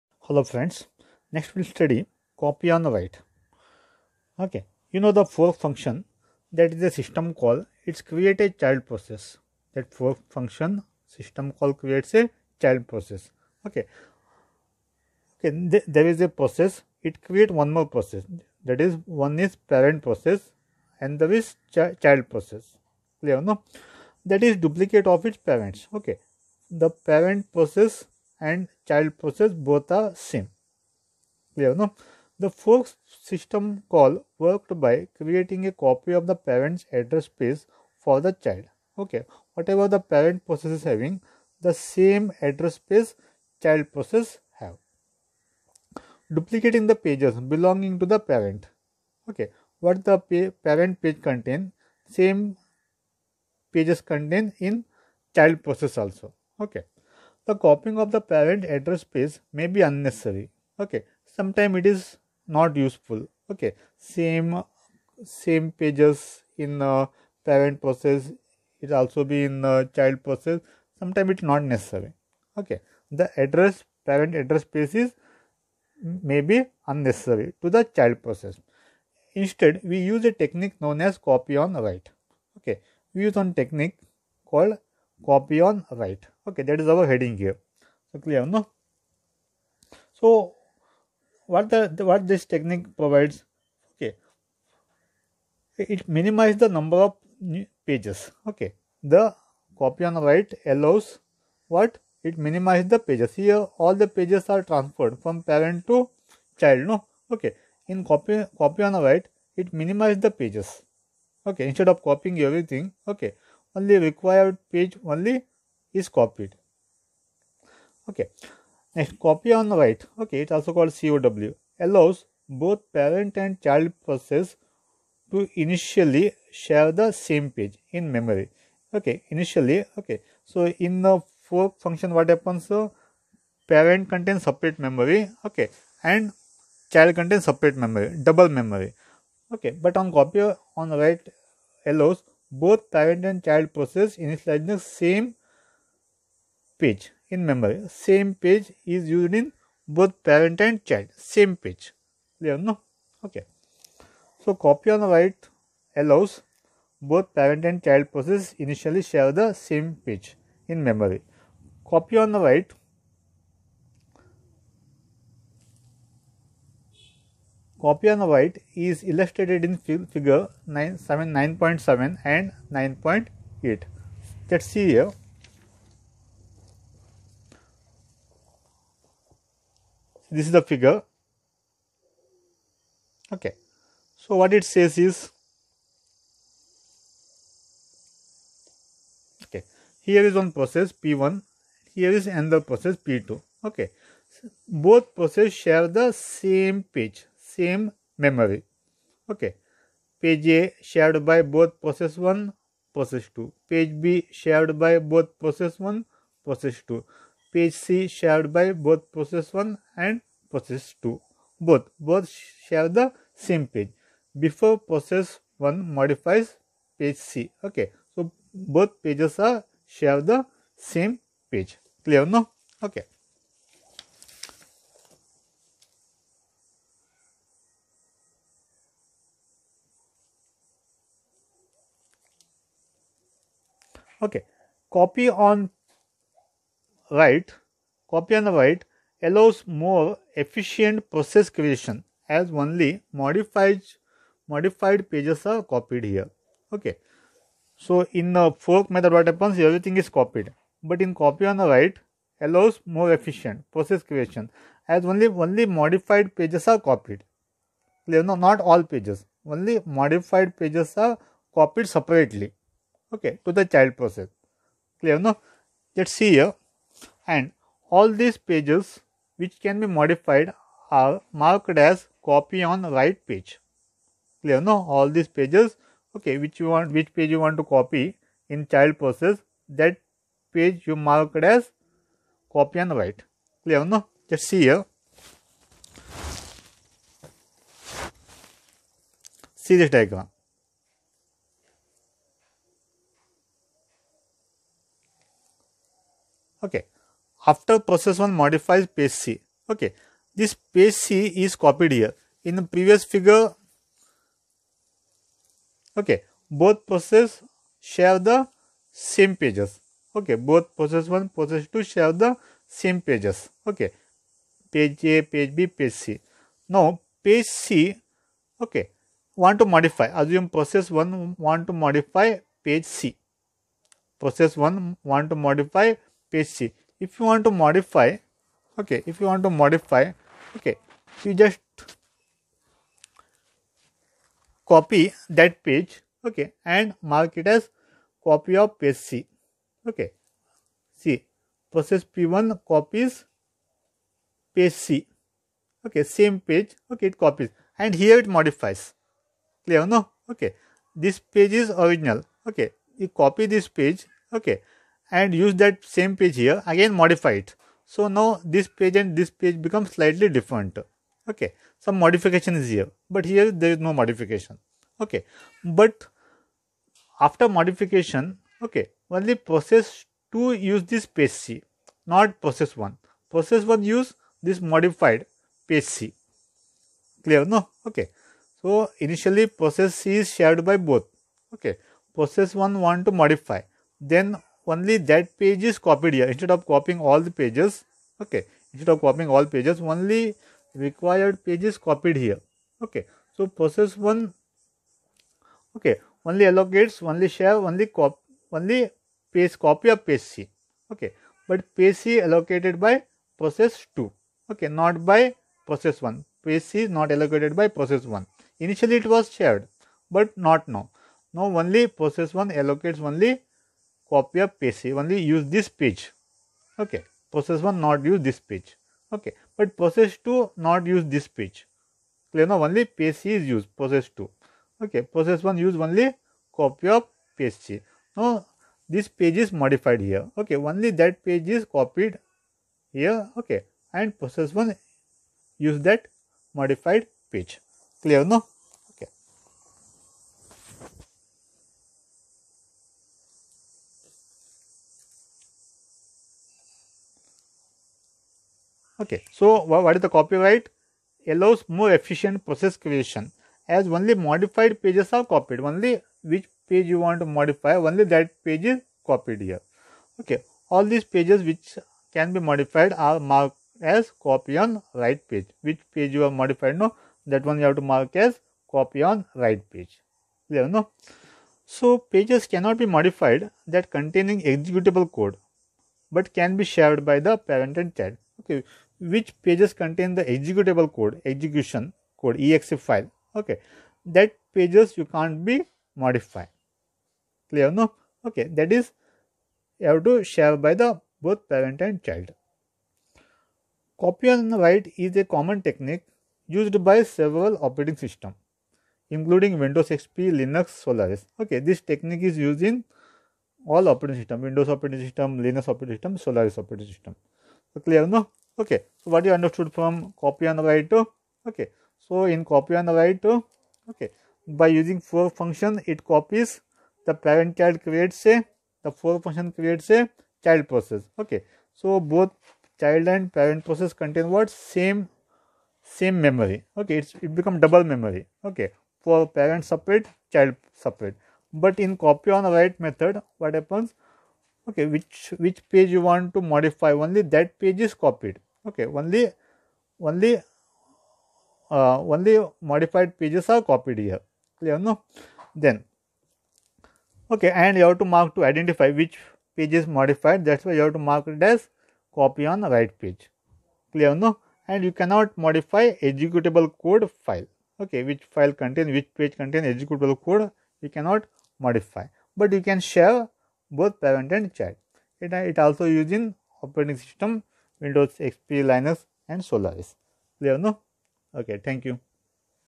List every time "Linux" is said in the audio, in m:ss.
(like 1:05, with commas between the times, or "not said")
8:20, 8:25, 9:28.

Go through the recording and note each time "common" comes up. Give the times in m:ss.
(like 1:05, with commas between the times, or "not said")
8:15.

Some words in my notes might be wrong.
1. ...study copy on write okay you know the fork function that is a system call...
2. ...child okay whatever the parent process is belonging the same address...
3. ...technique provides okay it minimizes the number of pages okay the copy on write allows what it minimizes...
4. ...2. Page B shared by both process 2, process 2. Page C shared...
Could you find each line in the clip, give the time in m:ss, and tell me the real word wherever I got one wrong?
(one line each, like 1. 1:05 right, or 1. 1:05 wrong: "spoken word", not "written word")
1. 0:01 right
2. 0:38 wrong: "having", not "belonging"
3. 1:32 right
4. 3:23 wrong: "1", not "2".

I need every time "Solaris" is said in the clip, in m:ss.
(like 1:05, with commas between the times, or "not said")
8:20, 8:26, 9:29.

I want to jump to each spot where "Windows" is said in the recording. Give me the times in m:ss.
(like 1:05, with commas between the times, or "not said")
8:19, 8:24, 9:27.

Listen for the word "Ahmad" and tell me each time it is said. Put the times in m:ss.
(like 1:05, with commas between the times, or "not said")
not said.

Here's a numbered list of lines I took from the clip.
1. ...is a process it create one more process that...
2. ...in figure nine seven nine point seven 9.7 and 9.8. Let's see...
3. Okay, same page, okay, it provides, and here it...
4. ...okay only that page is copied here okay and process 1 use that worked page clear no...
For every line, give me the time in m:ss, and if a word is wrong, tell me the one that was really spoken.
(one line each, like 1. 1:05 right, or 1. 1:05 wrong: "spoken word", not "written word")
1. 0:16 right
2. 2:49 right
3. 5:45 wrong: "copies", not "provides"
4. 7:10 wrong: "modified", not "worked".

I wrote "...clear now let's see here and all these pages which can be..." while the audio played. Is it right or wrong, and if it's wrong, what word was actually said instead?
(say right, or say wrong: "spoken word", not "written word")
right.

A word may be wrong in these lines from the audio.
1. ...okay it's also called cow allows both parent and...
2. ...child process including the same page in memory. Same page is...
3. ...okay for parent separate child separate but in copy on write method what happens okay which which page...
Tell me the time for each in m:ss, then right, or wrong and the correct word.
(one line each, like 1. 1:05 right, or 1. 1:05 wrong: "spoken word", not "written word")
1. 2:00 right
2. 2:23 wrong: "initializing", not "including"
3. 8:48 right.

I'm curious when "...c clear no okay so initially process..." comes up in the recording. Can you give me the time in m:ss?
6:15.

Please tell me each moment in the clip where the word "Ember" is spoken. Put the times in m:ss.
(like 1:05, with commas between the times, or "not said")
not said.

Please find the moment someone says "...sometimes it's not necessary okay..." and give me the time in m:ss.
1:10.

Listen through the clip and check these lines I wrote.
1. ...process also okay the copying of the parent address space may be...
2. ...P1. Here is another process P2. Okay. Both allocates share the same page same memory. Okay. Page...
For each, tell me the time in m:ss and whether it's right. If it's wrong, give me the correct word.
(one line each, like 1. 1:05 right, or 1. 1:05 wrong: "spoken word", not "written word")
1. 0:55 right
2. 3:10 wrong: "processes", not "allocates".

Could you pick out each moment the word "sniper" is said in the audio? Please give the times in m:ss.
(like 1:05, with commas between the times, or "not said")
not said.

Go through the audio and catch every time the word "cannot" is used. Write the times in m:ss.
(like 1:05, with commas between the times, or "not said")
7:52, 9:15, 9:20.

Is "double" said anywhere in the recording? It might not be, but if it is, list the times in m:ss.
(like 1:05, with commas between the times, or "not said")
2:18, 8:47.